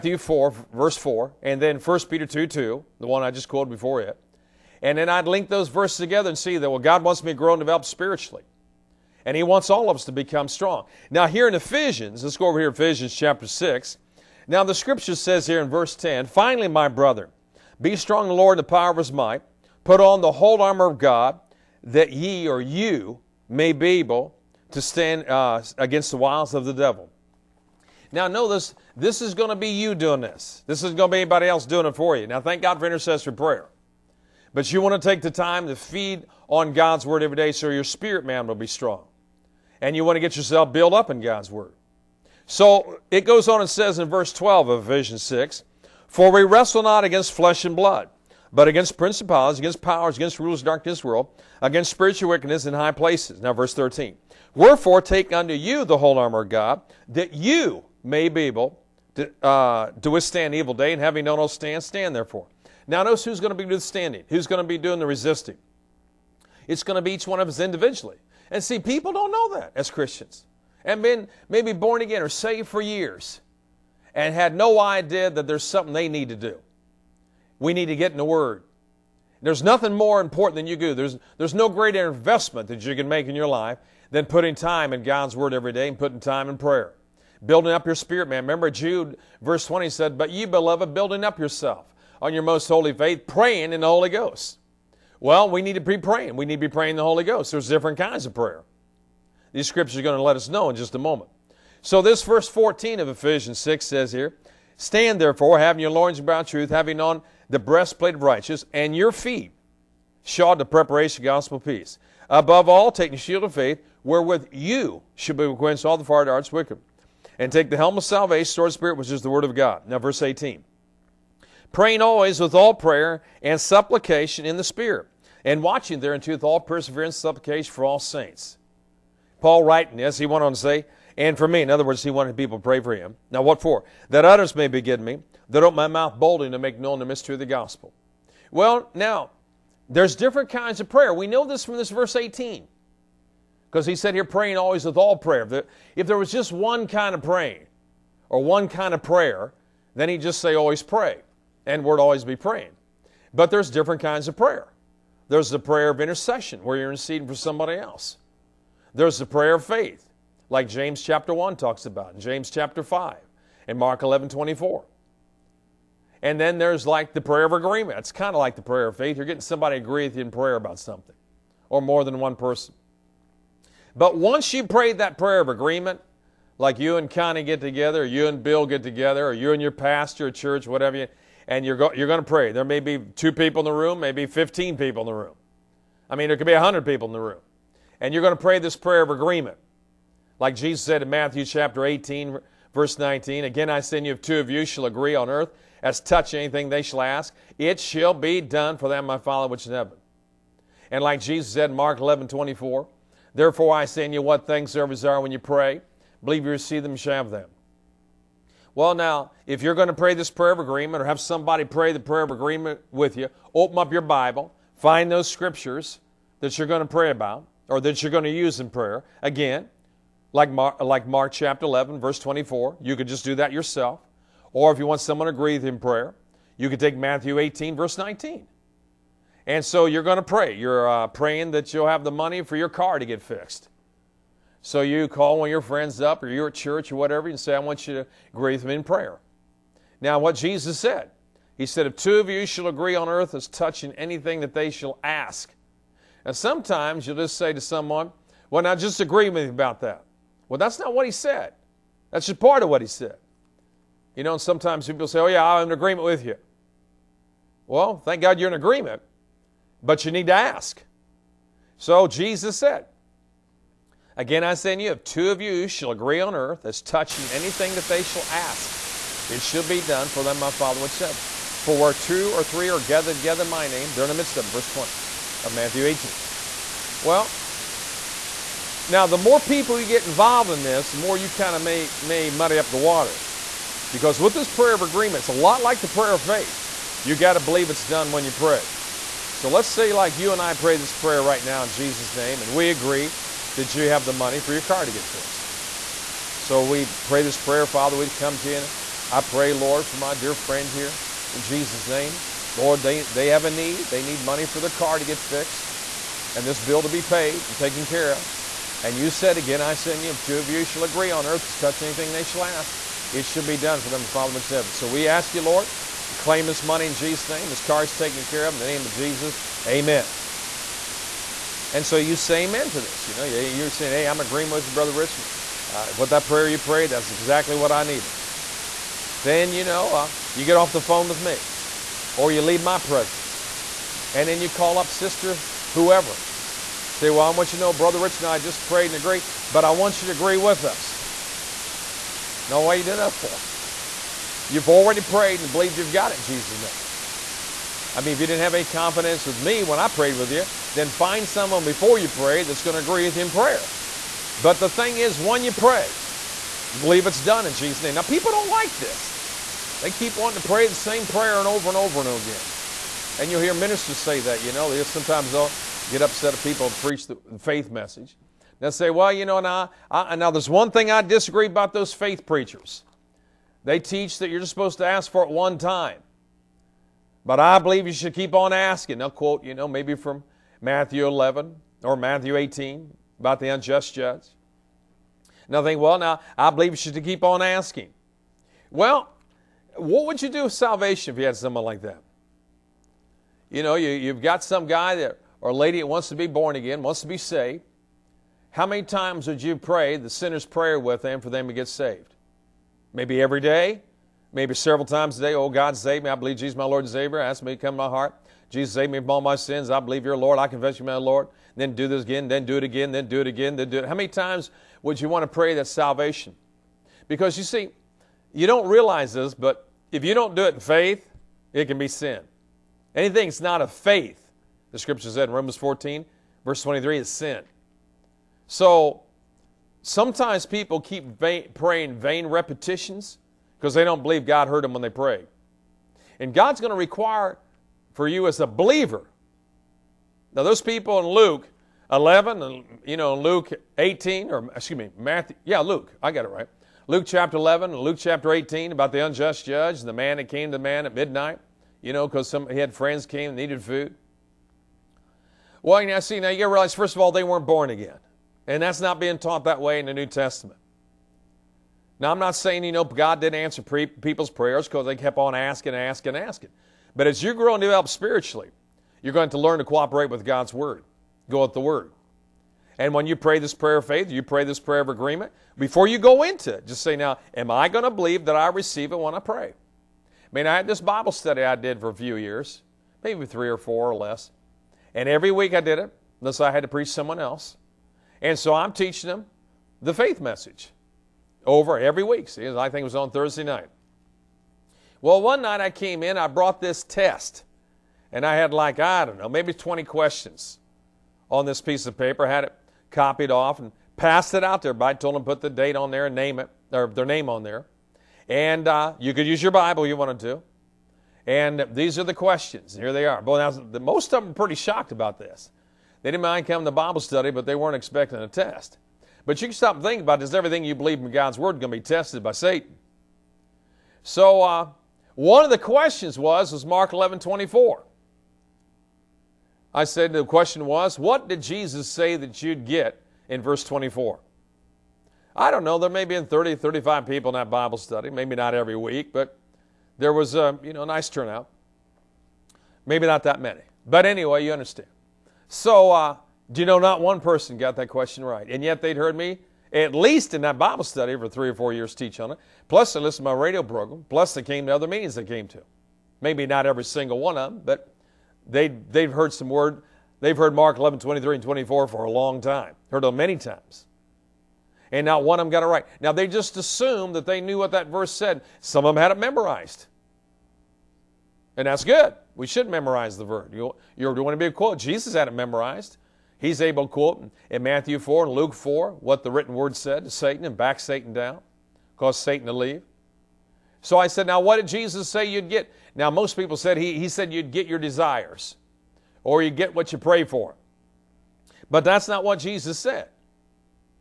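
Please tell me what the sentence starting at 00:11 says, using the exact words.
Now, here in Ephesians, let's go over here, Ephesians chapter 6.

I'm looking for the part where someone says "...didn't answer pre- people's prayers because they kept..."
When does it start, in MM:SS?
07:43.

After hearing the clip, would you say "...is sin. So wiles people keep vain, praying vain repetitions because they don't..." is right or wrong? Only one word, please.
wrong.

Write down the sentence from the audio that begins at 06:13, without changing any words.
They teach that you're just supposed to ask for it one time.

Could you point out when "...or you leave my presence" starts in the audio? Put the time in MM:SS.
05:32.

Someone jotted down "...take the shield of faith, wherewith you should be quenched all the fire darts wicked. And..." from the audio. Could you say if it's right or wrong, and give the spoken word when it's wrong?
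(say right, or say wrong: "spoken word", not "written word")
right.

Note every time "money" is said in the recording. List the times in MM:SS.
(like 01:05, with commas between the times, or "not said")
03:52, 04:54, 05:04, 05:16.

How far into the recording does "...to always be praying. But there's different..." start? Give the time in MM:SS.
02:31.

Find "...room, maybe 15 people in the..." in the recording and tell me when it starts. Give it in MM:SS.
03:03.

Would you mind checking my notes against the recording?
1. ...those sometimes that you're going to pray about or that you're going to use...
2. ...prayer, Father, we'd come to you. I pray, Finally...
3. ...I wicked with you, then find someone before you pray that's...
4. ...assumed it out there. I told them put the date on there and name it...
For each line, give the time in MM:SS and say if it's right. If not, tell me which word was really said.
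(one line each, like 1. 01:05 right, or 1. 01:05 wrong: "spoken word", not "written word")
1. 03:35 wrong: "scriptures", not "sometimes"
2. 04:57 wrong: "Lord", not "Finally"
3. 05:49 wrong: "prayed", not "wicked"
4. 08:23 wrong: "passed", not "assumed".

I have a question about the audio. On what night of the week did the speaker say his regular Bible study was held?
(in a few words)
Thursday.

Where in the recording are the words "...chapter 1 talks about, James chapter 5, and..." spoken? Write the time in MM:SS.
02:41.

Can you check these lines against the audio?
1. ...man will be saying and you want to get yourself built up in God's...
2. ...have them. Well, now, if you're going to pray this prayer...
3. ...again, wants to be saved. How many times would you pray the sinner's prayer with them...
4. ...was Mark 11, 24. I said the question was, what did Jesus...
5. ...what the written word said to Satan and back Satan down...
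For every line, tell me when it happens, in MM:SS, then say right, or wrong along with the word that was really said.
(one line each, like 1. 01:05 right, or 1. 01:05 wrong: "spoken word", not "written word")
1. 00:38 wrong: "strong", not "saying"
2. 03:27 right
3. 06:36 right
4. 08:46 right
5. 09:38 right.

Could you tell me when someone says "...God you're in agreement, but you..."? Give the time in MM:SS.
04:18.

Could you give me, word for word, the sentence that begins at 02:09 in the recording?
Paul writing this, he went on to say, and for me, in other words, he wanted people to pray for him.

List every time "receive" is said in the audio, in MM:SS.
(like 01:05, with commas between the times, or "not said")
03:26, 07:58.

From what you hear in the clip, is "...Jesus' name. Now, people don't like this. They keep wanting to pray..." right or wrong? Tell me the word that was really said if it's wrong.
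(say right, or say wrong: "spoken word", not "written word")
right.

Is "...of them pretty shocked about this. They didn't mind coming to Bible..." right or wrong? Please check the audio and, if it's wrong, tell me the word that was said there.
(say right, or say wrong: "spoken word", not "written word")
right.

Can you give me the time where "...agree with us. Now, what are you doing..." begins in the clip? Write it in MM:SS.
05:40.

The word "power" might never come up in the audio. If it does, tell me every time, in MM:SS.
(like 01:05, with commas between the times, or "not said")
00:18, 00:49.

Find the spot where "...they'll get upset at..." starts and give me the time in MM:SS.
06:05.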